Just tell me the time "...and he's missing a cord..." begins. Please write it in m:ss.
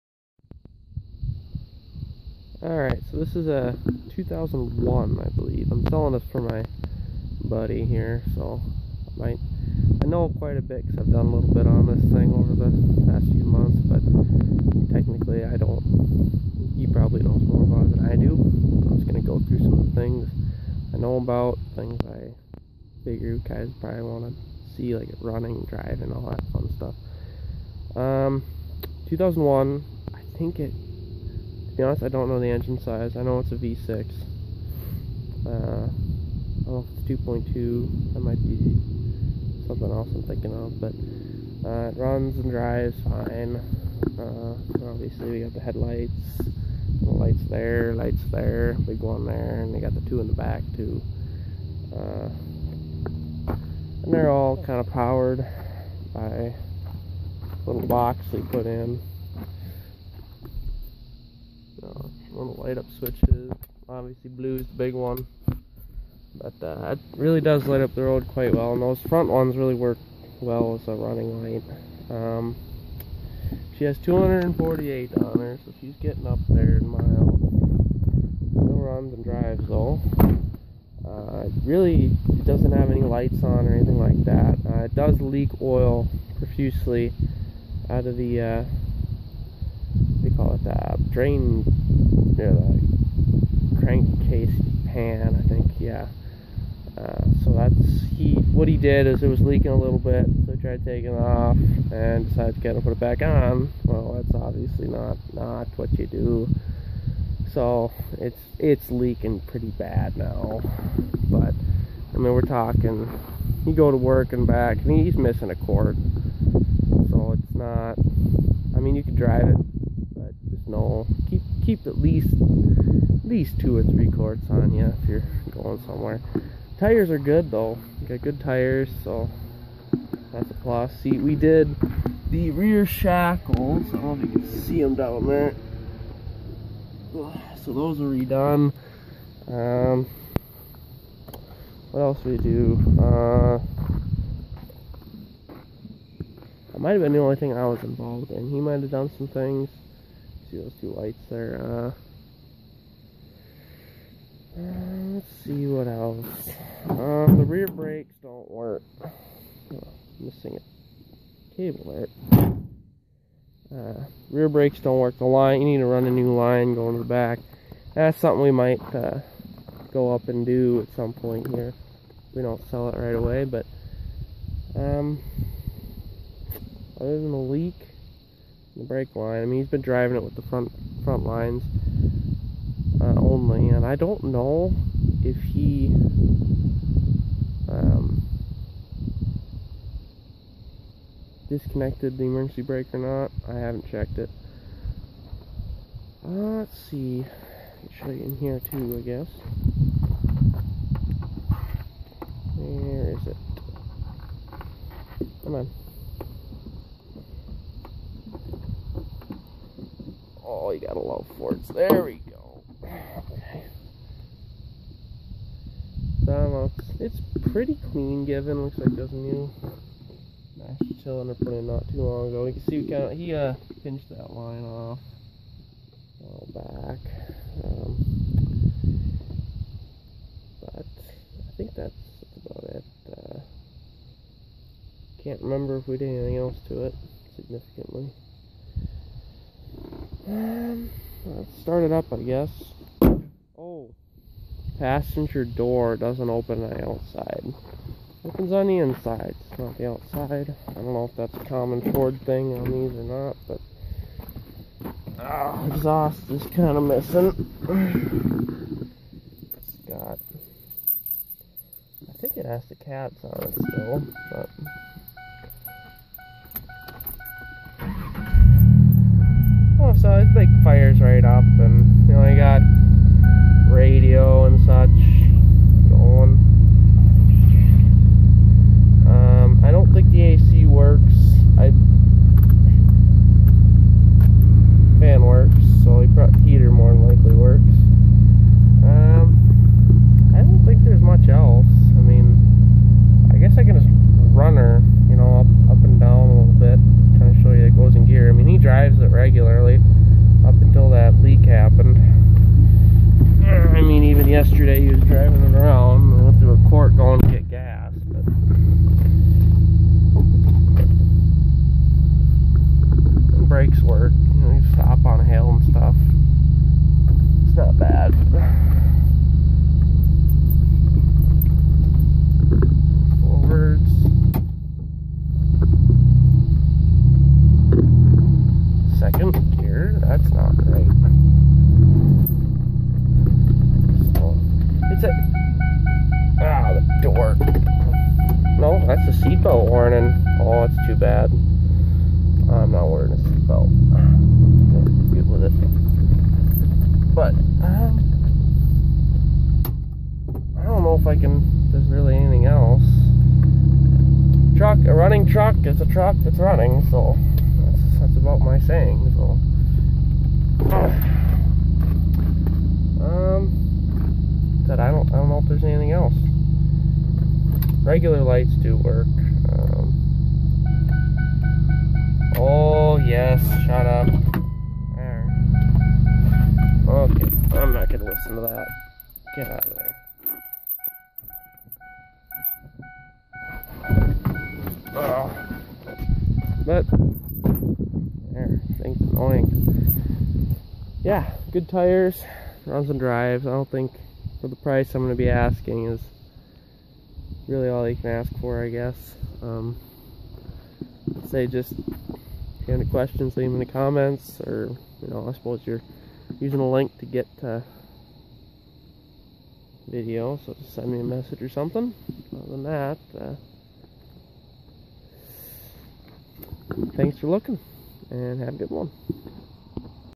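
1:54.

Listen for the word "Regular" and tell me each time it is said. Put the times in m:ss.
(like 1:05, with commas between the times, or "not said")
6:07.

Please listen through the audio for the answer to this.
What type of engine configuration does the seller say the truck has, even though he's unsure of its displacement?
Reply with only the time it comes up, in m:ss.
0:33.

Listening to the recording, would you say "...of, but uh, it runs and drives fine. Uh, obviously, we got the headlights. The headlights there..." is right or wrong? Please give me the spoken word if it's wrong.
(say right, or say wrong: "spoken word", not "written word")
wrong: "lights", not "headlights".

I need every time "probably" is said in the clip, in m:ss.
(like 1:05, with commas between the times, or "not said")
0:16, 0:23.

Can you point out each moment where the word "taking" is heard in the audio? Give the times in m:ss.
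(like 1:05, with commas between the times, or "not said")
1:40.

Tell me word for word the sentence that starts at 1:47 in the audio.
So it's it's leaking pretty bad now.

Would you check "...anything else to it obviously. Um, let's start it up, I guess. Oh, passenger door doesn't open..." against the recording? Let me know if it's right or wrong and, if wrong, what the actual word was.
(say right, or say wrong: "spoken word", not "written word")
wrong: "significantly", not "obviously".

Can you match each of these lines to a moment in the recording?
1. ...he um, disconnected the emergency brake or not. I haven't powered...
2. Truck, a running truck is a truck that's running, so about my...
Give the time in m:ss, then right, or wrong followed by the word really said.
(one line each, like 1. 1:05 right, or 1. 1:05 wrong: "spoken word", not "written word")
1. 3:05 wrong: "checked", not "powered"
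2. 5:54 right.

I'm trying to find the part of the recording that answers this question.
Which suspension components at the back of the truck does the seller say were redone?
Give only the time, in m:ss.
2:12.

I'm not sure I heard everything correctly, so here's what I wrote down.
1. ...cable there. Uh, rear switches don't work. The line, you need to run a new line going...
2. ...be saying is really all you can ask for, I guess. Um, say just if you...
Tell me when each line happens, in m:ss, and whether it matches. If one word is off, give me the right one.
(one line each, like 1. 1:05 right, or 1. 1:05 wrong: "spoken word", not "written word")
1. 2:41 wrong: "brakes", not "switches"
2. 6:35 wrong: "asking", not "saying".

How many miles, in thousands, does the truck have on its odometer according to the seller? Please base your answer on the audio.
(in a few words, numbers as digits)
248.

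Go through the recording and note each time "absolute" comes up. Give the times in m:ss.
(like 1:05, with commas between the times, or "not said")
not said.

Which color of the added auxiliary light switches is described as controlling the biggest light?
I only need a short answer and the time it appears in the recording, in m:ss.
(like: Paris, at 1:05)
Blue, at 1:04.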